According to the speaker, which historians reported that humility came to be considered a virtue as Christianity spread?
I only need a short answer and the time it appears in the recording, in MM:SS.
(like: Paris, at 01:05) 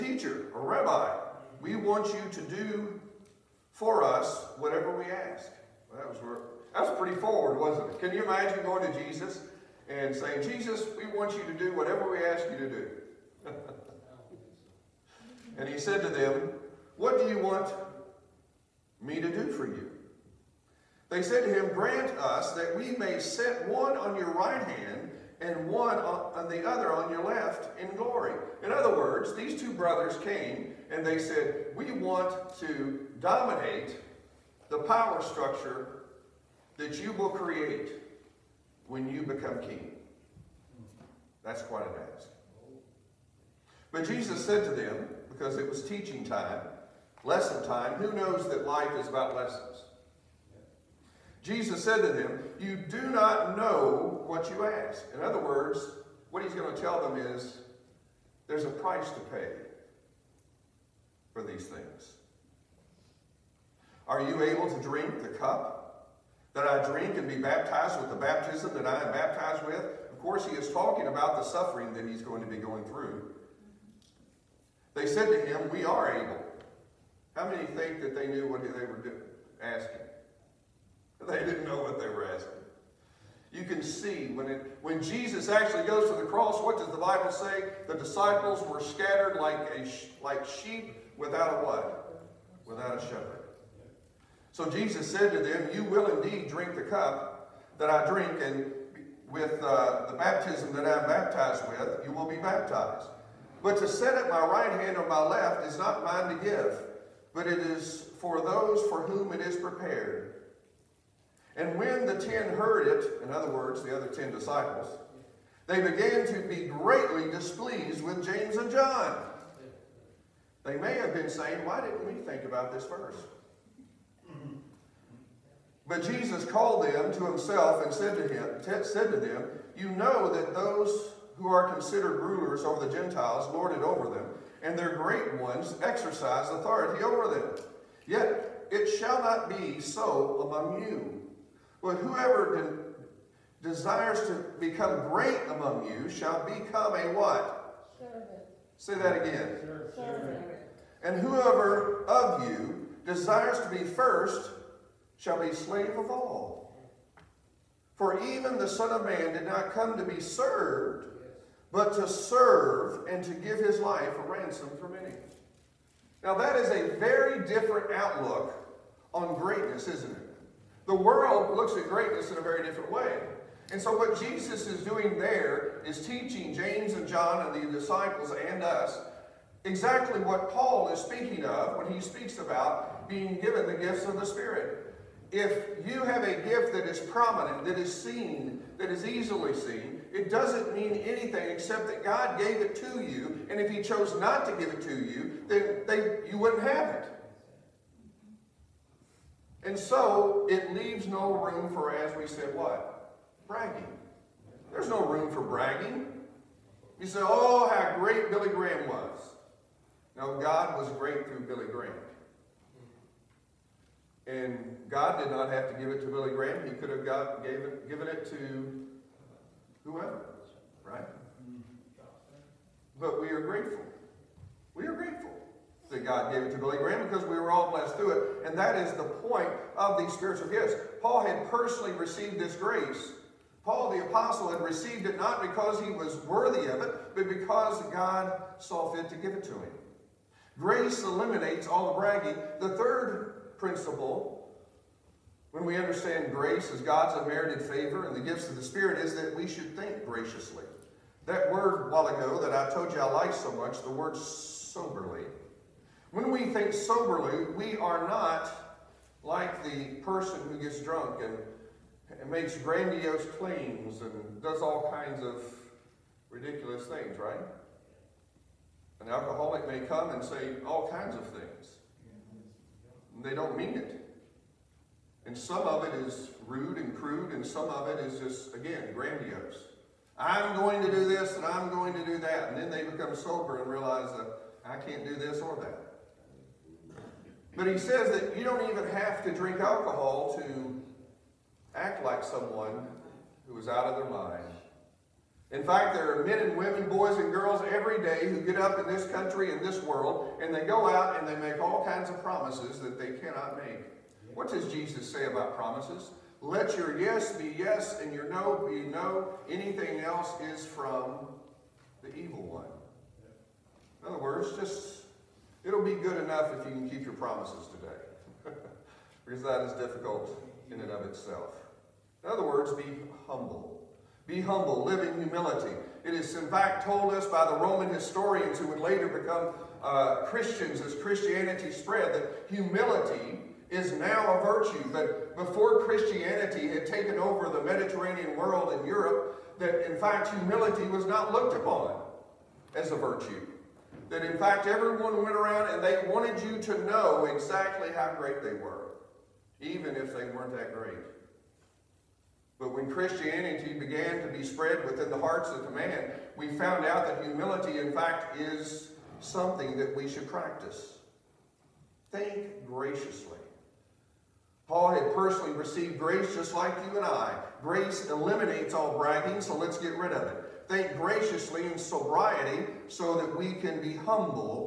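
Roman historians, at 05:27.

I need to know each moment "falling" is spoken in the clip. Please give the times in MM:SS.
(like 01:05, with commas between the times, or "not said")
not said.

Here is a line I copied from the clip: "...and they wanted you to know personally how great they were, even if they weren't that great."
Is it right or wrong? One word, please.
wrong.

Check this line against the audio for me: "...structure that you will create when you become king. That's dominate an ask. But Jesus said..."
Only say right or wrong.
wrong.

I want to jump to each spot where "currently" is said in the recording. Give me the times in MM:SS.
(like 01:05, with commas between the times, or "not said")
not said.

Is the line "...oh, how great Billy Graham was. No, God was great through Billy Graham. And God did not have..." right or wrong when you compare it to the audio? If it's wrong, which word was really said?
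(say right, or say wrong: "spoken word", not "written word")
right.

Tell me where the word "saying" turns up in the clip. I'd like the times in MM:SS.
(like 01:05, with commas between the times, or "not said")
00:10, 02:01.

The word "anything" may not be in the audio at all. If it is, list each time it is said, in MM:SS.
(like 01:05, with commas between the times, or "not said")
03:11, 05:09.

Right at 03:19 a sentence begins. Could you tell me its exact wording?
And so it leaves no room for, as we said, what?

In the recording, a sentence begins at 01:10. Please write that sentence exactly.
Of course, he is talking about the suffering that he's going to be going through.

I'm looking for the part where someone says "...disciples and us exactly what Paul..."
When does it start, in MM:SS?
02:57.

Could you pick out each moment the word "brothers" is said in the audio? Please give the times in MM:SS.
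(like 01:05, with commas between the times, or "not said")
00:29.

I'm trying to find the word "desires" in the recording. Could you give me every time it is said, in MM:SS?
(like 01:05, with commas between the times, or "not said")
02:23, 02:33.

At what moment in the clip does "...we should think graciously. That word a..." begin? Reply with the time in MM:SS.
04:09.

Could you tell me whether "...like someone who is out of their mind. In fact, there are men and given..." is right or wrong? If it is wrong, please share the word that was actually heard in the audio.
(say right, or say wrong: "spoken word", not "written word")
wrong: "women", not "given".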